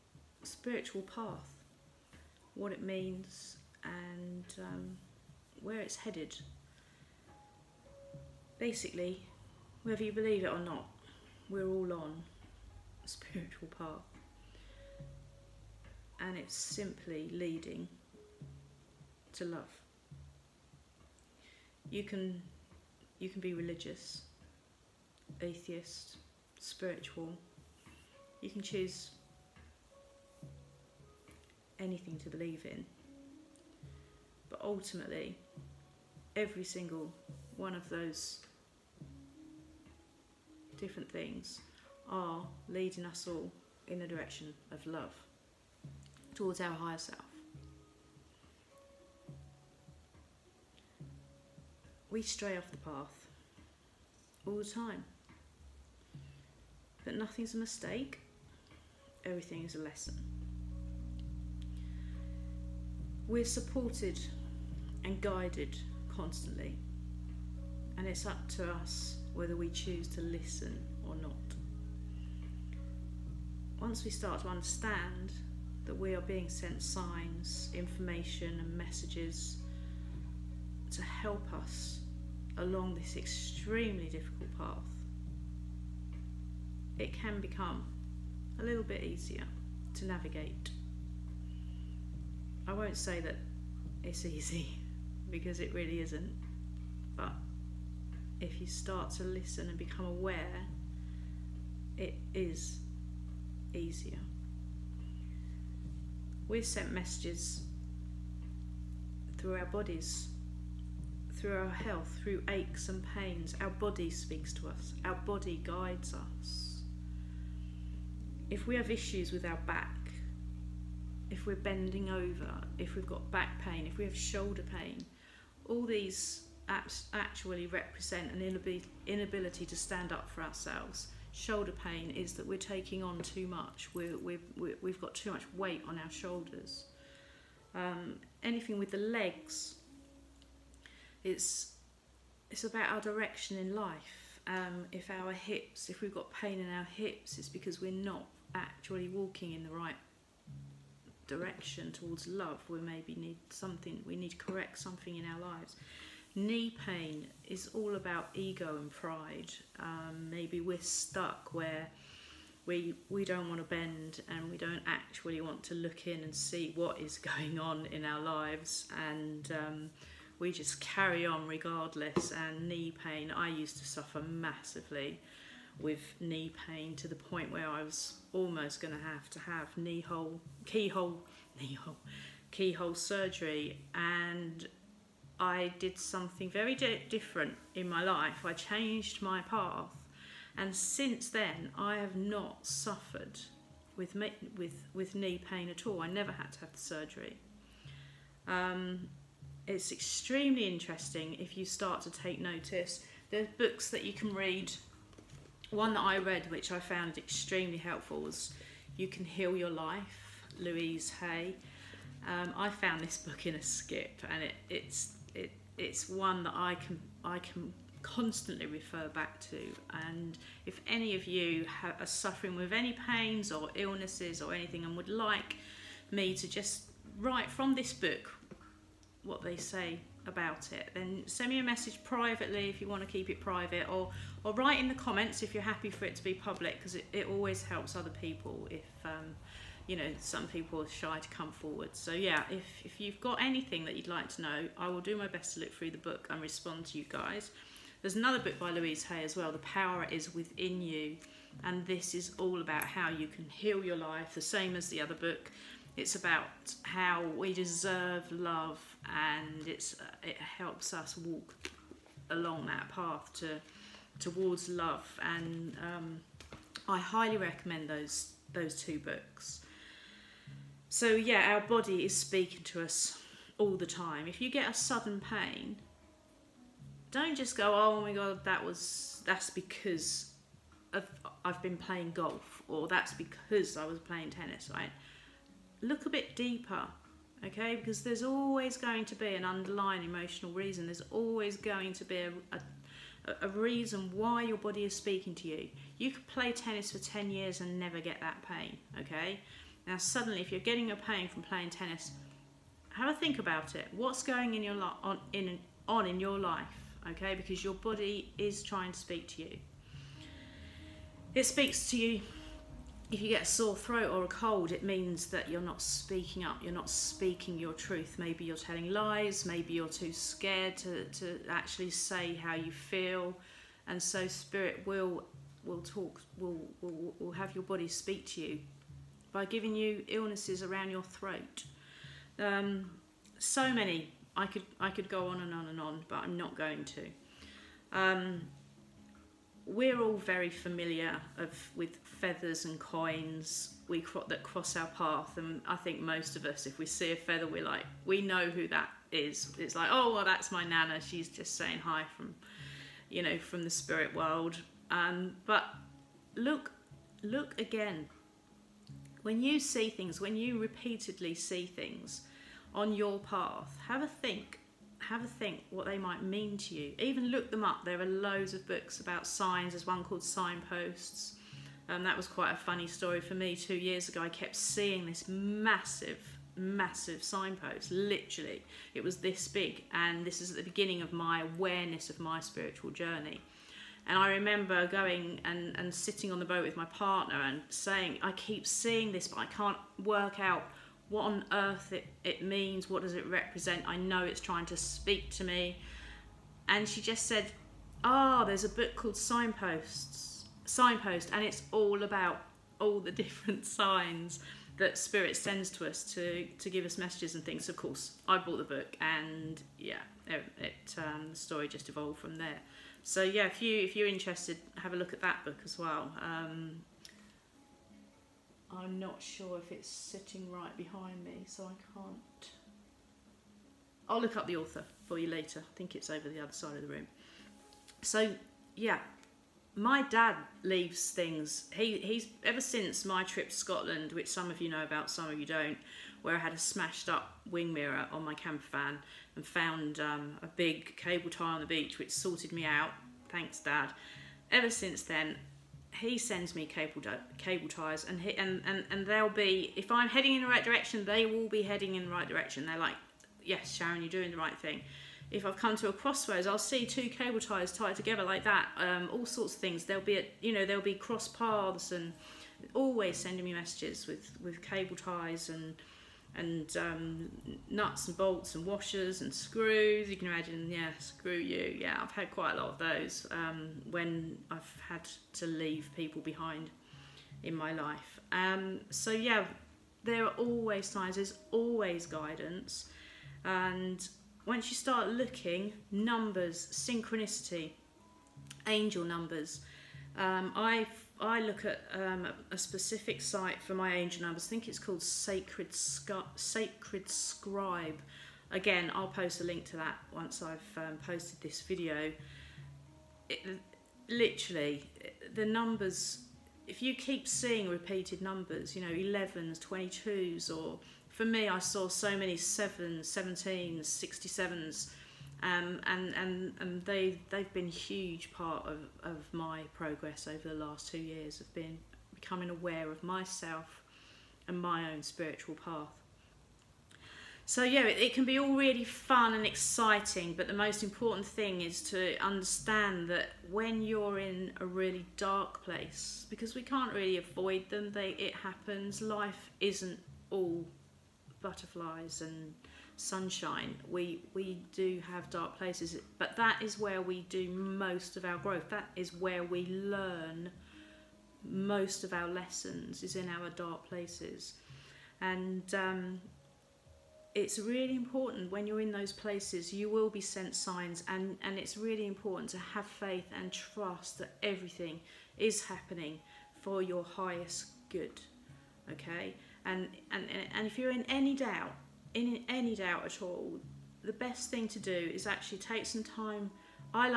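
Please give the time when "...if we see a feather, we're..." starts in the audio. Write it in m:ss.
5:46.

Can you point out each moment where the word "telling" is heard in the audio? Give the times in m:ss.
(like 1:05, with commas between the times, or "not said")
5:18.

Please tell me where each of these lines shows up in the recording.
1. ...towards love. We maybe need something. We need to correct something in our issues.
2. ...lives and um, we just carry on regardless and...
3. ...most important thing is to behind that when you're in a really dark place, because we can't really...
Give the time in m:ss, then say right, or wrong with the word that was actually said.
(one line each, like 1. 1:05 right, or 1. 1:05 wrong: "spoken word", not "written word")
1. 2:31 wrong: "lives", not "issues"
2. 2:48 right
3. 8:50 wrong: "understand", not "behind".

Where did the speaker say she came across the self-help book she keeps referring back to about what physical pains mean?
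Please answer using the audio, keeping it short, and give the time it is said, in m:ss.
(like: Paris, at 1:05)
In a skip, at 3:33.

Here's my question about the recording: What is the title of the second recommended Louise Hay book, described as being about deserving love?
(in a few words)
The Power Is Within You.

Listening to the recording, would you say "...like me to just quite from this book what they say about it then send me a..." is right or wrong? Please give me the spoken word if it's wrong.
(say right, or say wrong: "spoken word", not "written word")
wrong: "write", not "quite".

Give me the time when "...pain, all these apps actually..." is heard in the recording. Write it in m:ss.
2:04.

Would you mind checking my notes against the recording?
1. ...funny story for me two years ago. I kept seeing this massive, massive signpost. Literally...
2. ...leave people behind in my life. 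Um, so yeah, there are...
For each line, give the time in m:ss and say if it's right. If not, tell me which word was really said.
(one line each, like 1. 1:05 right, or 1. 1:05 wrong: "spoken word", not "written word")
1. 6:12 right
2. 7:55 right.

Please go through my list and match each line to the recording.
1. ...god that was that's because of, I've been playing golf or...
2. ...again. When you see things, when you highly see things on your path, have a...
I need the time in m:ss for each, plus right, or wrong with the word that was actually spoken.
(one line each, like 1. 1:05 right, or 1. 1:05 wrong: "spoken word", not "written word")
1. 4:38 right
2. 5:57 wrong: "repeatedly", not "highly".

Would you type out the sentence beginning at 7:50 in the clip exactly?
You can imagine, yeah, screw you.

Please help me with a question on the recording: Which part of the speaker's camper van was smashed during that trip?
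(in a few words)
Wing mirror.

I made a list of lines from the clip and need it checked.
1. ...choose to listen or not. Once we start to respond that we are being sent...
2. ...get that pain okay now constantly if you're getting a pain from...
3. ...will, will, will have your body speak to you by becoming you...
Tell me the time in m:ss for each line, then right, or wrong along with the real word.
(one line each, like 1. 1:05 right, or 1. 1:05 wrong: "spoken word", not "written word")
1. 1:09 wrong: "understand", not "respond"
2. 4:57 wrong: "suddenly", not "constantly"
3. 5:26 wrong: "giving", not "becoming".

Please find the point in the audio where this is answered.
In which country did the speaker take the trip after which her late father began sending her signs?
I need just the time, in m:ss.
7:13.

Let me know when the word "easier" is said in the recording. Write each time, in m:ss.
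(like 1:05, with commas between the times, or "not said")
1:29, 1:43.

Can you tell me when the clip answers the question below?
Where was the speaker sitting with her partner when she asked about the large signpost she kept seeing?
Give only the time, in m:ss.
6:26.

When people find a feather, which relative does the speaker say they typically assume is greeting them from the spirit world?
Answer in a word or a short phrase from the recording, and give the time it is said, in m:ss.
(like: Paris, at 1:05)
Nana, at 5:50.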